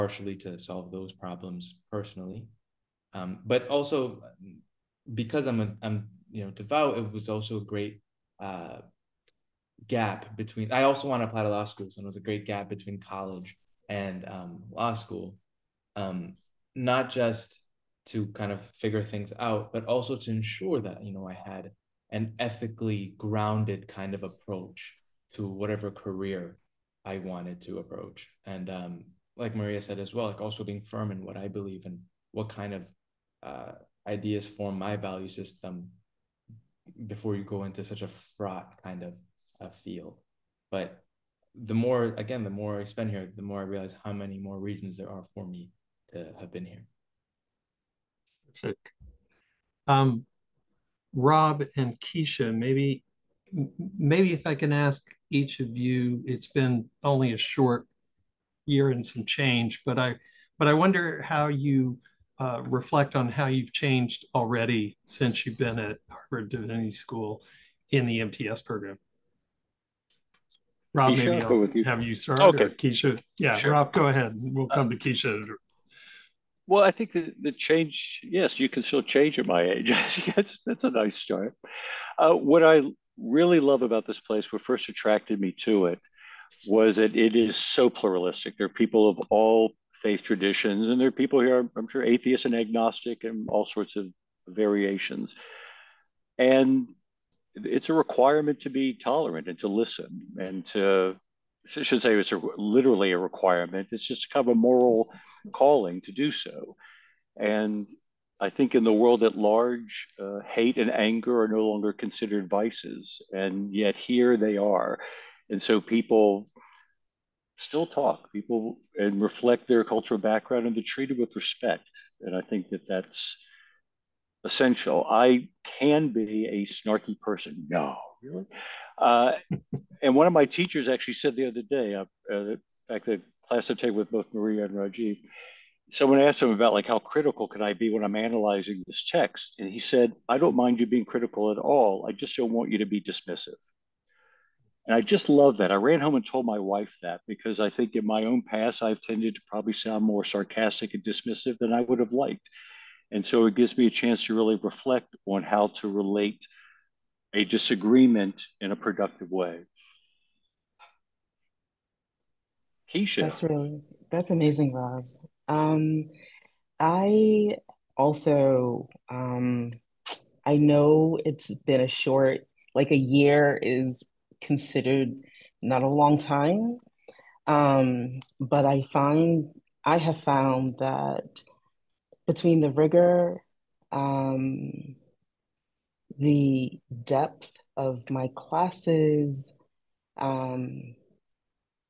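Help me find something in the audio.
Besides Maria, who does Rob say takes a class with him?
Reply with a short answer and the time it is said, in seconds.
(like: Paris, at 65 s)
Rajiv, at 134 s.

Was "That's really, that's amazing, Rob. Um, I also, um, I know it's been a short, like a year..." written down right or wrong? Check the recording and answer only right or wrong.
right.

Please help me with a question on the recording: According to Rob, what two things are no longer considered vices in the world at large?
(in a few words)
Hate and anger.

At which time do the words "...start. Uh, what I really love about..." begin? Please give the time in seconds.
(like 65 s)
81 s.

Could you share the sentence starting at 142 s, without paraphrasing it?
I just don't want you to be dismissive." And I just love that.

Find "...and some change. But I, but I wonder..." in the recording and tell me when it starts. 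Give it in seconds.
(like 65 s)
58 s.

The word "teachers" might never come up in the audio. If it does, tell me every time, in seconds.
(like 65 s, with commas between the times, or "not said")
130 s.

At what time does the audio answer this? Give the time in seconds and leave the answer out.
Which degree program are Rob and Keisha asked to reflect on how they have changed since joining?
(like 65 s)
68 s.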